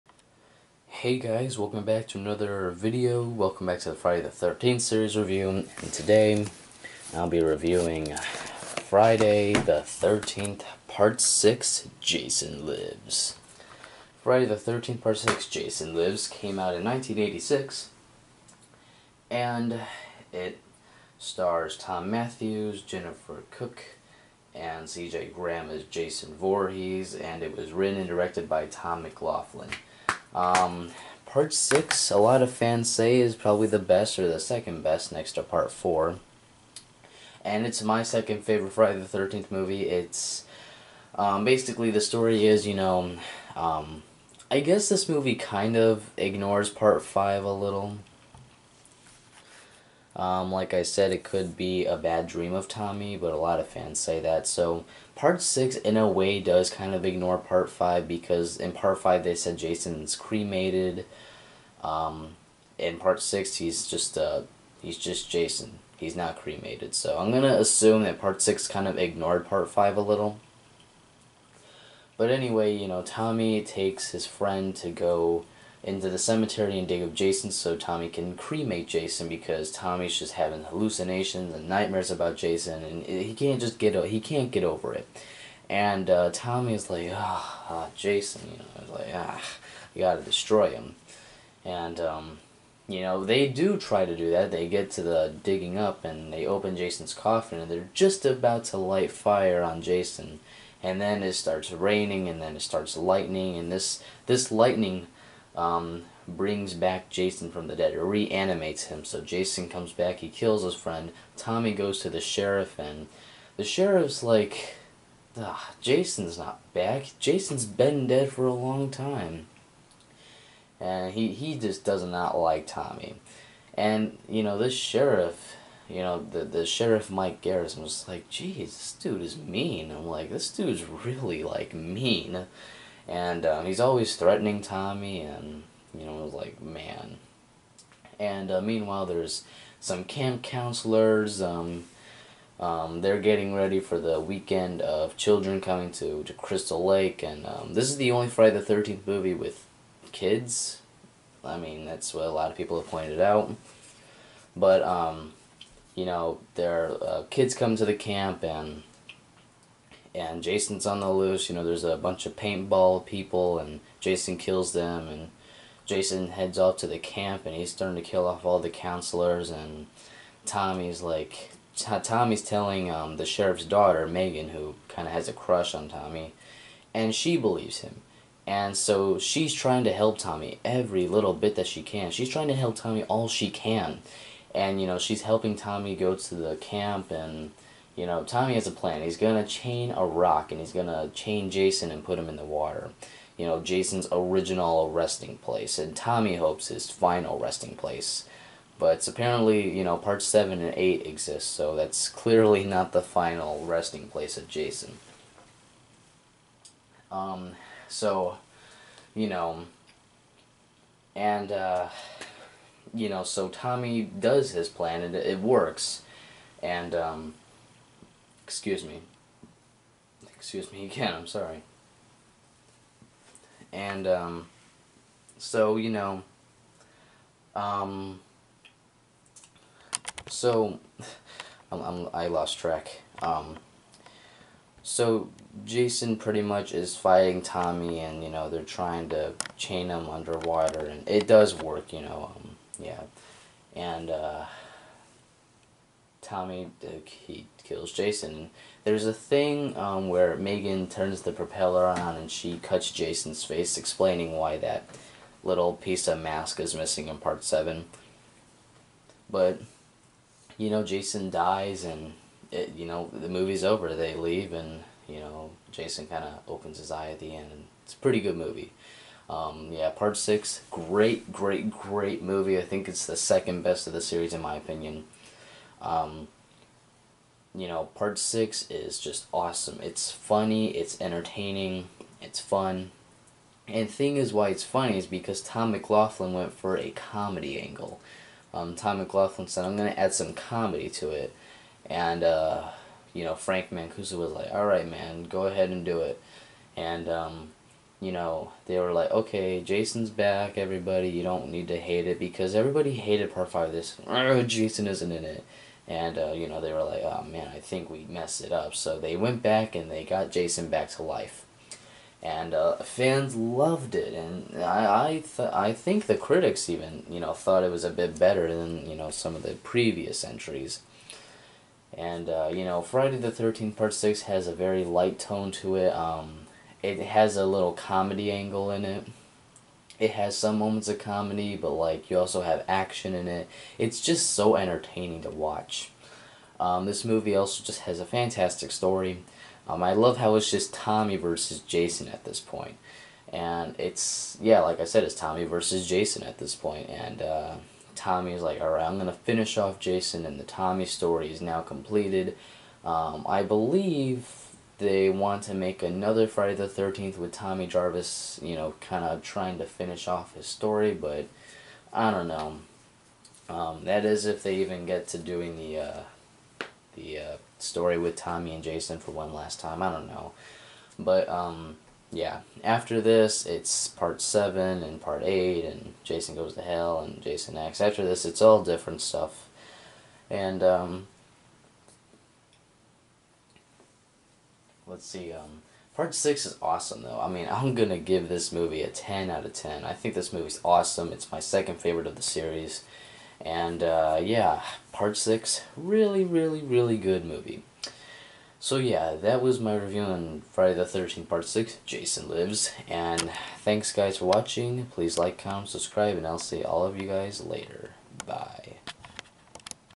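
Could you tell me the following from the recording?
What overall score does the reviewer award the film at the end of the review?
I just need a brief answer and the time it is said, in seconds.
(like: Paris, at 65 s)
10 out of 10, at 388 s.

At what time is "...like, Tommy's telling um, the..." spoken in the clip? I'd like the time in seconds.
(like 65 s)
171 s.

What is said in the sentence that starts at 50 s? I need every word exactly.
Um, like I said, it could be a bad dream of Tommy, but a lot of fans say that.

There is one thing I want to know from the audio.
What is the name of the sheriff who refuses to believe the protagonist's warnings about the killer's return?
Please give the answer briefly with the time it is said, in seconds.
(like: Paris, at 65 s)
Mike Garrison, at 127 s.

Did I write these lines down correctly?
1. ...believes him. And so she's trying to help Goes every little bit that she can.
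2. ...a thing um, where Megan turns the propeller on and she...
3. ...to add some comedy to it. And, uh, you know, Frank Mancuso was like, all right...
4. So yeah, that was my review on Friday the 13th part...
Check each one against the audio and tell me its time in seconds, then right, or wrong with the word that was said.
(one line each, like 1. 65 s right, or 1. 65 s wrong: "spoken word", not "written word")
1. 177 s wrong: "Tommy", not "Goes"
2. 249 s right
3. 289 s right
4. 398 s right.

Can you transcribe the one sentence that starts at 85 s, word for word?
And uh, like, ah, oh, Jason, you know, like ah, you gotta destroy him.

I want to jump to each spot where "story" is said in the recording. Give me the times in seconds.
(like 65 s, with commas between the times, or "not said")
42 s, 338 s, 350 s, 360 s, 367 s.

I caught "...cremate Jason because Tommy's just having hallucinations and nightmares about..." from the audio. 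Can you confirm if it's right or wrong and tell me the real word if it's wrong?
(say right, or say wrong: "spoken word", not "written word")
right.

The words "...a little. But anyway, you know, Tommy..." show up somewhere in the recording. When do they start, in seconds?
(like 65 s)
69 s.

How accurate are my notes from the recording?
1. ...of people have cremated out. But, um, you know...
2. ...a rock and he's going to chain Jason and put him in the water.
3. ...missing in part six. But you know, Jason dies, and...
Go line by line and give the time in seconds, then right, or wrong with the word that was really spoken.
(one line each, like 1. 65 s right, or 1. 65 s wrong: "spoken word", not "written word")
1. 152 s wrong: "pointed", not "cremated"
2. 189 s right
3. 256 s wrong: "seven", not "six".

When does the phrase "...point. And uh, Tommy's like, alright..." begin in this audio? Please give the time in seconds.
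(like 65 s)
346 s.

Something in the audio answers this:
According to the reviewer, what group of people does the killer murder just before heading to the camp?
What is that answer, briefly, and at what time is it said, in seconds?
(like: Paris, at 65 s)
paintball people, at 162 s.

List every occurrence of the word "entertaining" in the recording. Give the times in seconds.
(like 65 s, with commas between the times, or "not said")
281 s, 334 s.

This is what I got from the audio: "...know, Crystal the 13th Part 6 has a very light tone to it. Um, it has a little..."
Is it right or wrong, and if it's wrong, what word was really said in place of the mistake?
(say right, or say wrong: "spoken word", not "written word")
wrong: "Friday", not "Crystal".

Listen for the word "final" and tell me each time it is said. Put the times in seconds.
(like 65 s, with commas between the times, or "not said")
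196 s, 203 s.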